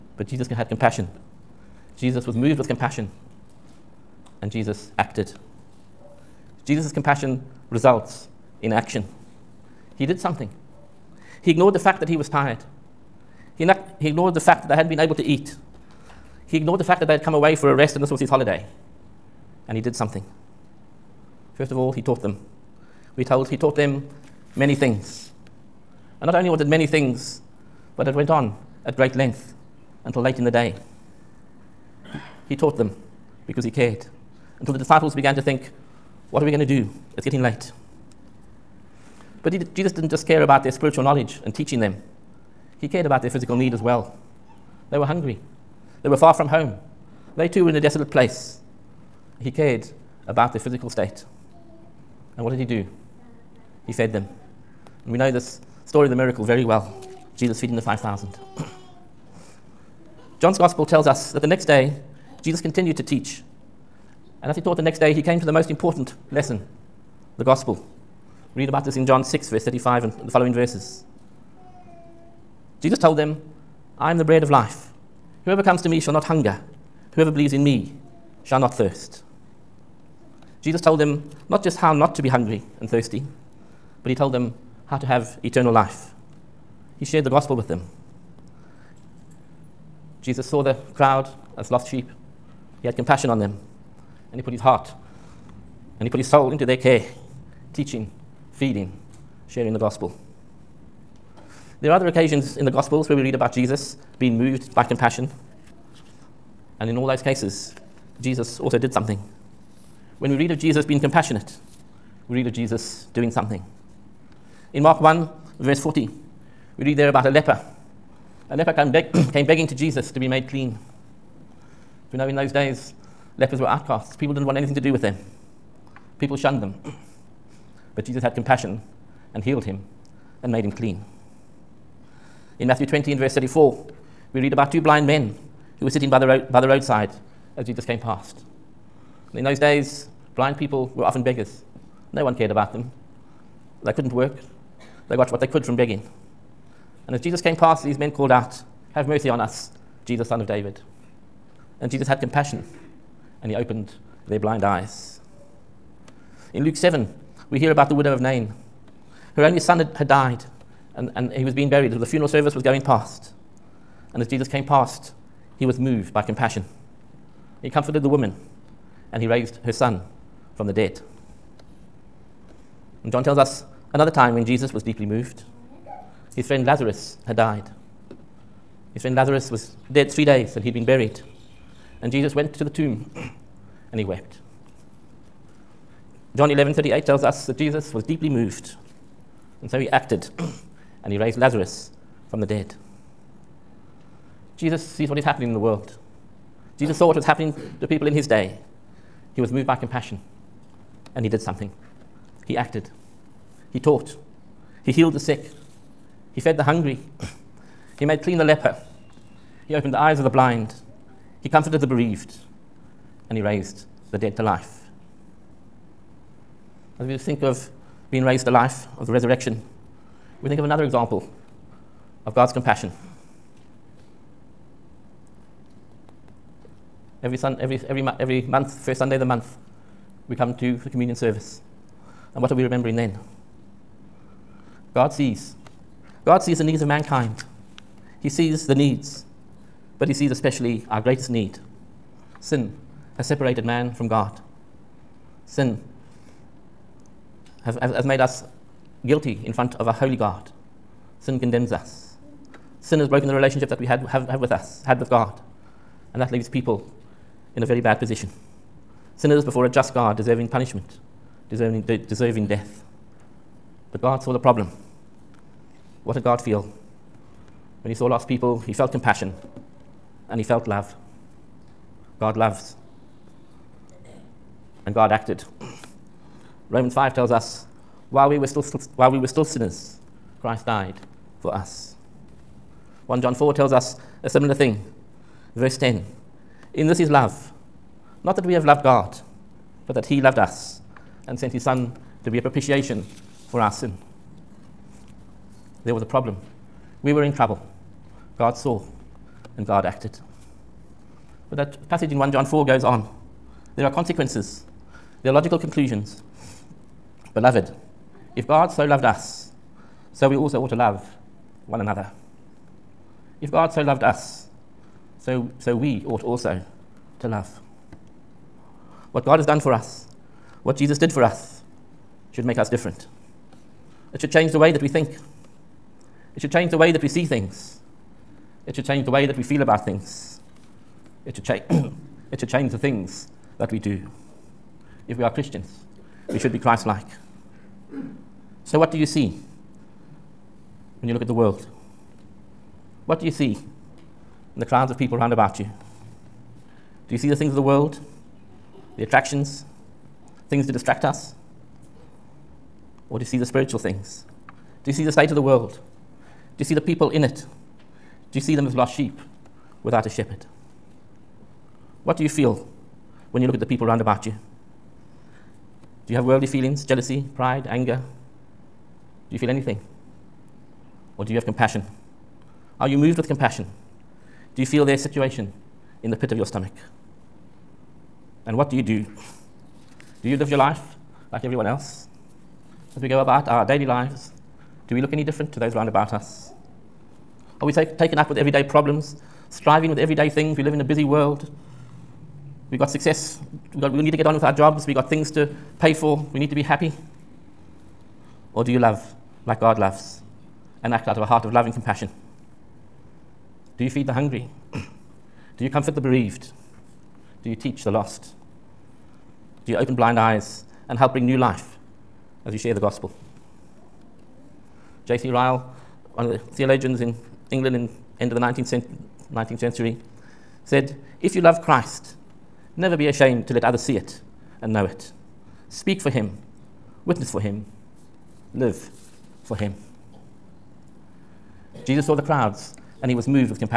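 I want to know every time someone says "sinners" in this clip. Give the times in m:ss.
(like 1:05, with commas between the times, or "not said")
4:19, 4:39.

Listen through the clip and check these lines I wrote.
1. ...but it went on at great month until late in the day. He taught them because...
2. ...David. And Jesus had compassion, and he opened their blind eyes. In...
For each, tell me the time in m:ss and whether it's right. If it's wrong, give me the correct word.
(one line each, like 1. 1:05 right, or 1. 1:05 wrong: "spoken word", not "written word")
1. 0:27 wrong: "length", not "month"
2. 2:30 right.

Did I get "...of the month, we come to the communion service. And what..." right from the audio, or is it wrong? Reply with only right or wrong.
right.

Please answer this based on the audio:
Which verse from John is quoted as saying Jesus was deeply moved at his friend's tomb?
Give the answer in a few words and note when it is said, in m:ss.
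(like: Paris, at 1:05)
John 11:38, at 3:06.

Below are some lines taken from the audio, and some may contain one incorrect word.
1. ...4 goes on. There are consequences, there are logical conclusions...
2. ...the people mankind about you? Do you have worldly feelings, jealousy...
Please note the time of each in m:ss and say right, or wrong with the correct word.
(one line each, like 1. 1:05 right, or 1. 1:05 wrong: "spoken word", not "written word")
1. 5:02 right
2. 6:03 wrong: "round", not "mankind".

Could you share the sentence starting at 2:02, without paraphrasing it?
You know, in those days, lepers were outcasts.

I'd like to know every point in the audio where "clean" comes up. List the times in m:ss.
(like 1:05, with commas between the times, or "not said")
2:00, 2:10, 3:28.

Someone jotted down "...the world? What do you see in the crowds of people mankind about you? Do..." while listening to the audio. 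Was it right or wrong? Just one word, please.
wrong.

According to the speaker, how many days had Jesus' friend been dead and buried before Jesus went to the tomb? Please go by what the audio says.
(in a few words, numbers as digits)
3.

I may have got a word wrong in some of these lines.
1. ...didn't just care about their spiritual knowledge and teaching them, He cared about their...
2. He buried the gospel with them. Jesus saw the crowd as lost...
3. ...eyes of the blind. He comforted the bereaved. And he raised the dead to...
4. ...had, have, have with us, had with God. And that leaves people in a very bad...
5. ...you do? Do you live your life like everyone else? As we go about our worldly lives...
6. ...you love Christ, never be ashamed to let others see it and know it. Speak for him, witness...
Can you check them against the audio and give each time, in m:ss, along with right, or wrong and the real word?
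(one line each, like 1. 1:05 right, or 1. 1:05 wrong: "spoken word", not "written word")
1. 0:39 right
2. 1:26 wrong: "shared", not "buried"
3. 3:29 right
4. 4:13 right
5. 6:18 wrong: "daily", not "worldly"
6. 7:01 right.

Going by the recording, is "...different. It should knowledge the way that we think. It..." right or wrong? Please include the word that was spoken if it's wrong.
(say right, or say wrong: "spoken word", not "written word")
wrong: "change", not "knowledge".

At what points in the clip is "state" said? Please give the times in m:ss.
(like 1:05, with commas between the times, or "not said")
0:50, 5:55.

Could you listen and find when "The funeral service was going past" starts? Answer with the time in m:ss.
2:41.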